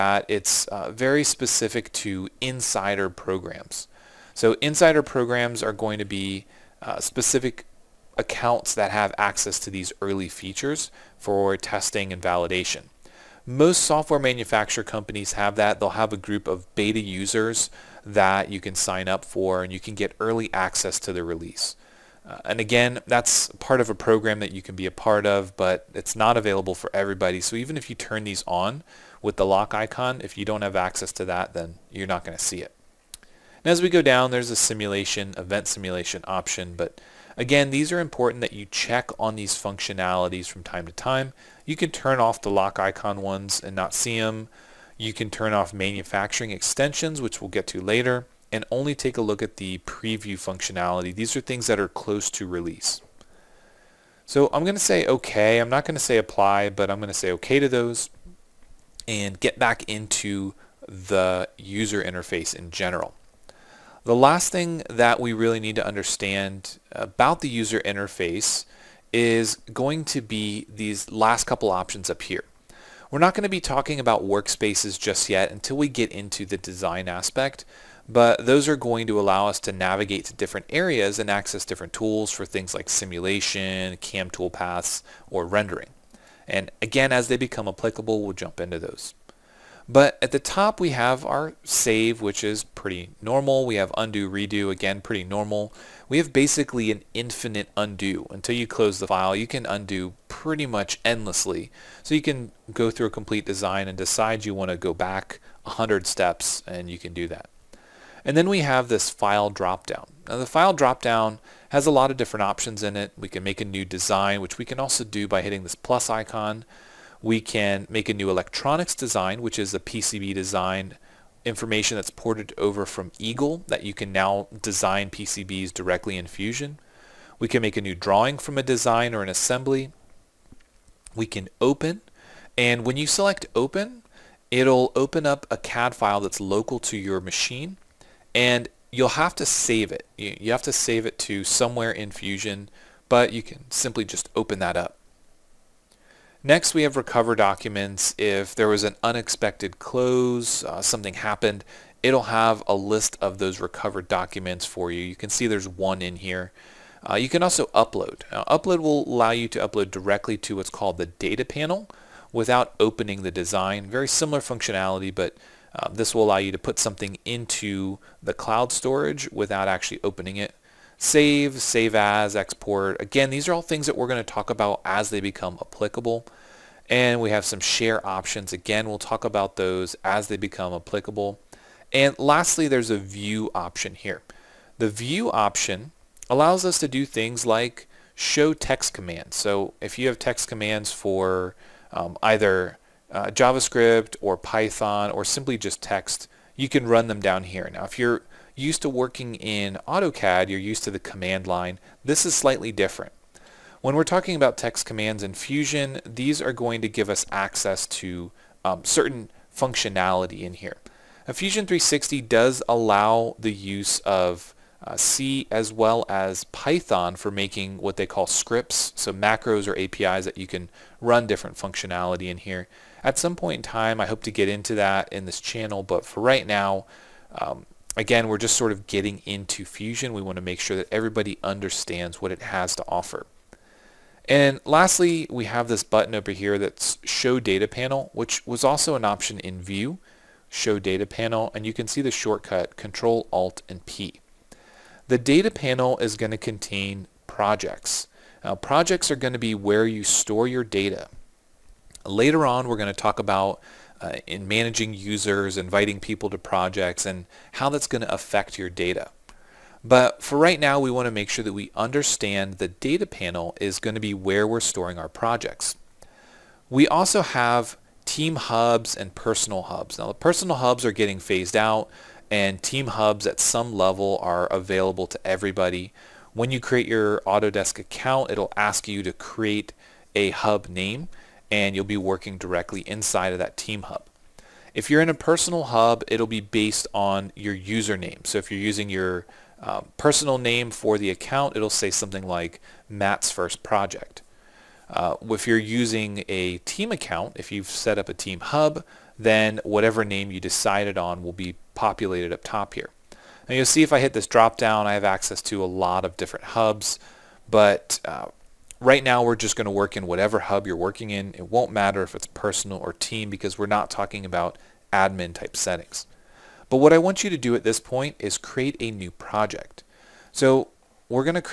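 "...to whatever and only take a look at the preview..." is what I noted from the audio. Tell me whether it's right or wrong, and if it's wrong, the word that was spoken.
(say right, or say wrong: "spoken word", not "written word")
wrong: "later", not "whatever".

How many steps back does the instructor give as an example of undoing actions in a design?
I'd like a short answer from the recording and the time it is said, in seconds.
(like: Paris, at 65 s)
100, at 105 s.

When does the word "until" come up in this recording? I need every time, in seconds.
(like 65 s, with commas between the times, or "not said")
75 s, 98 s.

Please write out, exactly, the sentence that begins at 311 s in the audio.
It won't matter if it's personal or team because we're not talking about admin type settings.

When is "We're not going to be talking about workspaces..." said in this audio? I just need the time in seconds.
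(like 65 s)
73 s.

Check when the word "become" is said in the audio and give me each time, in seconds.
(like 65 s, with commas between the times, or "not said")
87 s, 175 s, 180 s.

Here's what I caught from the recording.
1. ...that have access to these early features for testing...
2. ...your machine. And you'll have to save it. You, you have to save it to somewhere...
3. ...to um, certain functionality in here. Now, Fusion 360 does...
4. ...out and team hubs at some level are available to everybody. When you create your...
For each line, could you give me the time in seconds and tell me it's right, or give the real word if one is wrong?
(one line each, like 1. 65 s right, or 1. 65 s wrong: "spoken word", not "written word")
1. 8 s right
2. 136 s right
3. 207 s right
4. 271 s right.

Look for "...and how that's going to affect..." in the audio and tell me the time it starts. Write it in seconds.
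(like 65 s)
257 s.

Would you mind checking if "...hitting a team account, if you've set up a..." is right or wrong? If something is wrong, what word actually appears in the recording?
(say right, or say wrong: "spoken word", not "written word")
wrong: "using", not "hitting".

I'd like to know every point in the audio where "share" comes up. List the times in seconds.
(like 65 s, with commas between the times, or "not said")
177 s.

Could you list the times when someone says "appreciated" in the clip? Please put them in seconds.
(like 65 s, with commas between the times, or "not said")
not said.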